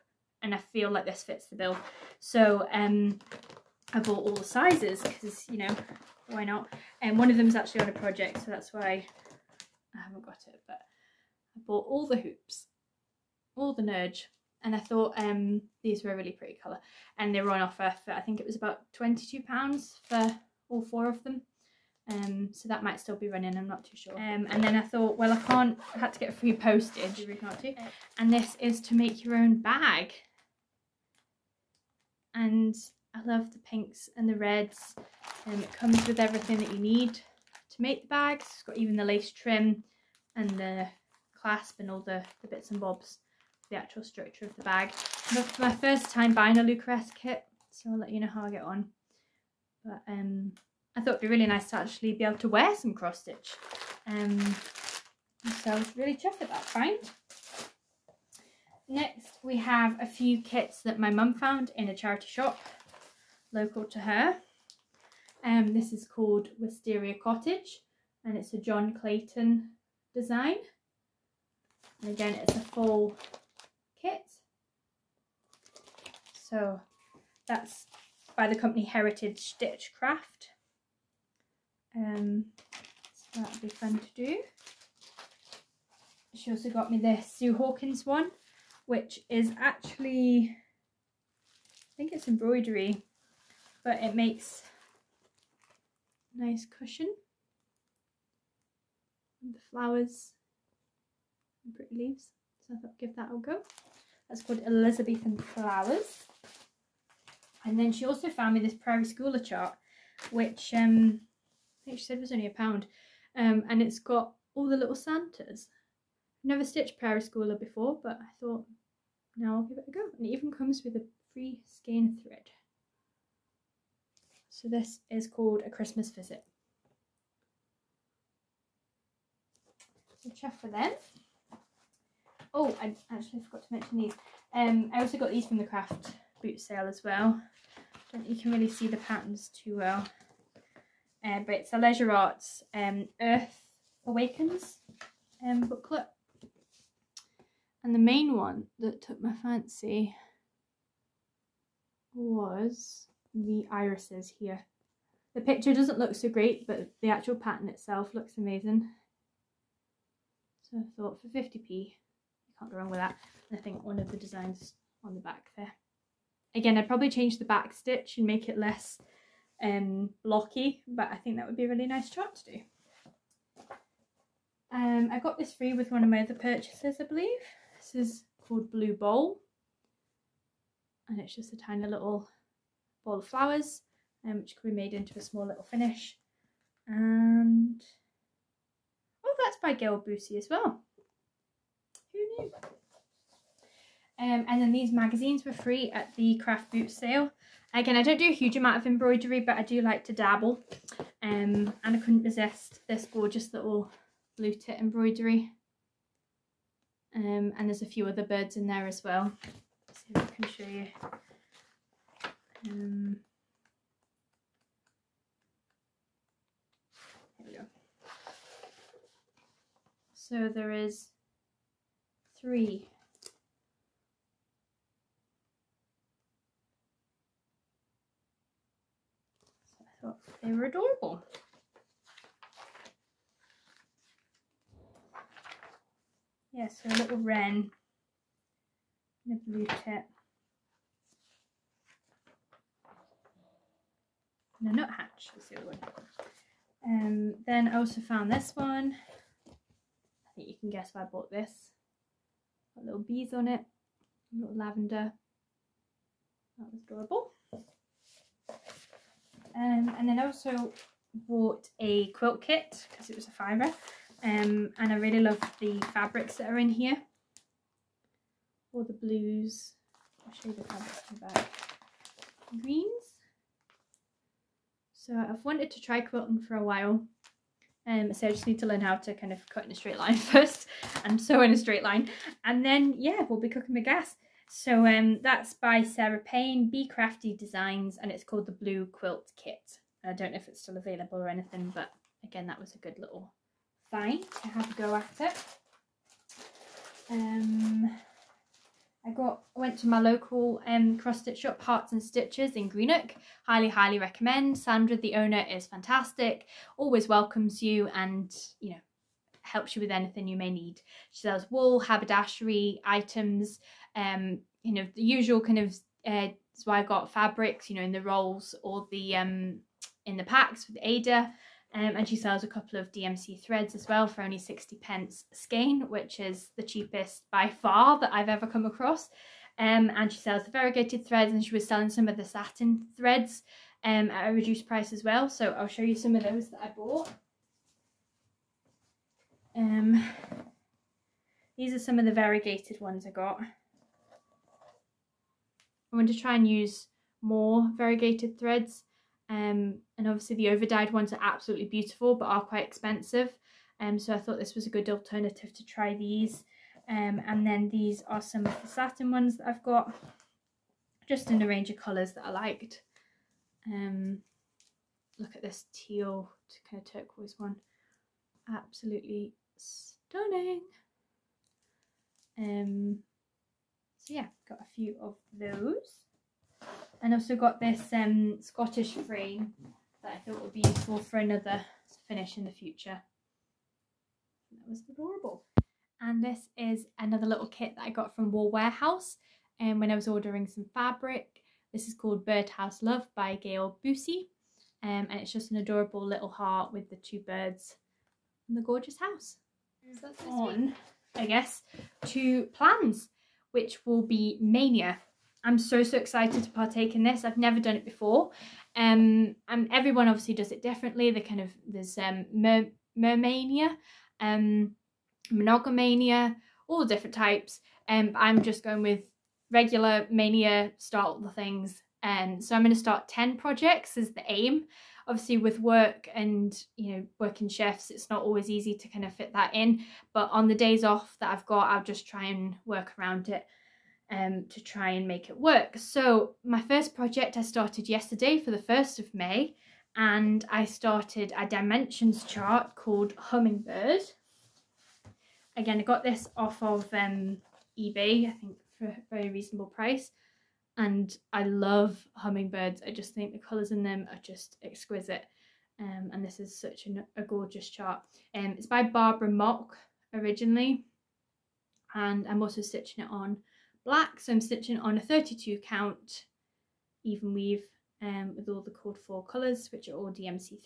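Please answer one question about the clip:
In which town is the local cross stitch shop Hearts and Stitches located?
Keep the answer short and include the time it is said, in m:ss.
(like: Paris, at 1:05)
Greenock, at 5:02.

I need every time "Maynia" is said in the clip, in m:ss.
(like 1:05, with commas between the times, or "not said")
6:44, 7:00.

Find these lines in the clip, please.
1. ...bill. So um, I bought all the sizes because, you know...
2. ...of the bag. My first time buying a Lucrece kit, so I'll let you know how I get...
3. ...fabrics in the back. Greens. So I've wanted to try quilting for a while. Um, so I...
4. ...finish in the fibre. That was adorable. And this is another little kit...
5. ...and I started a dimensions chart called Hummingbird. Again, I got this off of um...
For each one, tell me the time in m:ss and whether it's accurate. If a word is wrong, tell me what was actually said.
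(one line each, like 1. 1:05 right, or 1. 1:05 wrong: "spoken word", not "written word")
1. 0:01 right
2. 0:44 right
3. 4:30 right
4. 6:22 wrong: "future", not "fibre"
5. 7:19 right.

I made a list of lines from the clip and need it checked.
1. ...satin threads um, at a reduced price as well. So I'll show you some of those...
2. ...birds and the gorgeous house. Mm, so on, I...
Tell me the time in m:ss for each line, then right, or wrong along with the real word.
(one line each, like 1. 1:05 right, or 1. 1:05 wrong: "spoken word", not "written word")
1. 5:32 right
2. 6:37 right.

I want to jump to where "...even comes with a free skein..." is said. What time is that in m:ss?
2:00.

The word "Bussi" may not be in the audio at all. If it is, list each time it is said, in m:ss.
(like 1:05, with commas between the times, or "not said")
3:10, 6:33.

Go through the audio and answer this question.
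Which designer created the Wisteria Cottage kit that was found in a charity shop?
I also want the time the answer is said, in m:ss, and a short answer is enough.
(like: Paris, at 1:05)
John Clayton, at 1:08.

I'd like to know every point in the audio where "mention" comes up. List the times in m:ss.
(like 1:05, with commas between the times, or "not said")
2:13.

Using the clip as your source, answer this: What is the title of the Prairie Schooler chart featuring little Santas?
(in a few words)
A Christmas Visit.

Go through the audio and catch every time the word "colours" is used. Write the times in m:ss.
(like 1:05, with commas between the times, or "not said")
0:16, 6:01, 7:33, 7:49.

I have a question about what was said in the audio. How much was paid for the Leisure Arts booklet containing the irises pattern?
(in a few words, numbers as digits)
50p.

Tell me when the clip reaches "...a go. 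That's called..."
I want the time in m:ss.
1:43.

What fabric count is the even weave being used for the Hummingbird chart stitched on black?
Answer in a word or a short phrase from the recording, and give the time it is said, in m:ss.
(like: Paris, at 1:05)
32, at 7:45.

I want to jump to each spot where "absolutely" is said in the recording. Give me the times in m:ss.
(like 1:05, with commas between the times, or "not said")
5:51, 6:08.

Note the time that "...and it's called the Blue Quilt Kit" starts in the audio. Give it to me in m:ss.
4:48.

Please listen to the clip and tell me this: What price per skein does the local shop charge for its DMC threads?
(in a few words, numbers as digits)
60 pence.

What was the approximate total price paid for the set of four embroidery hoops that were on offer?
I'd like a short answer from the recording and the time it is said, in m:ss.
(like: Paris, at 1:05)
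£22, at 0:18.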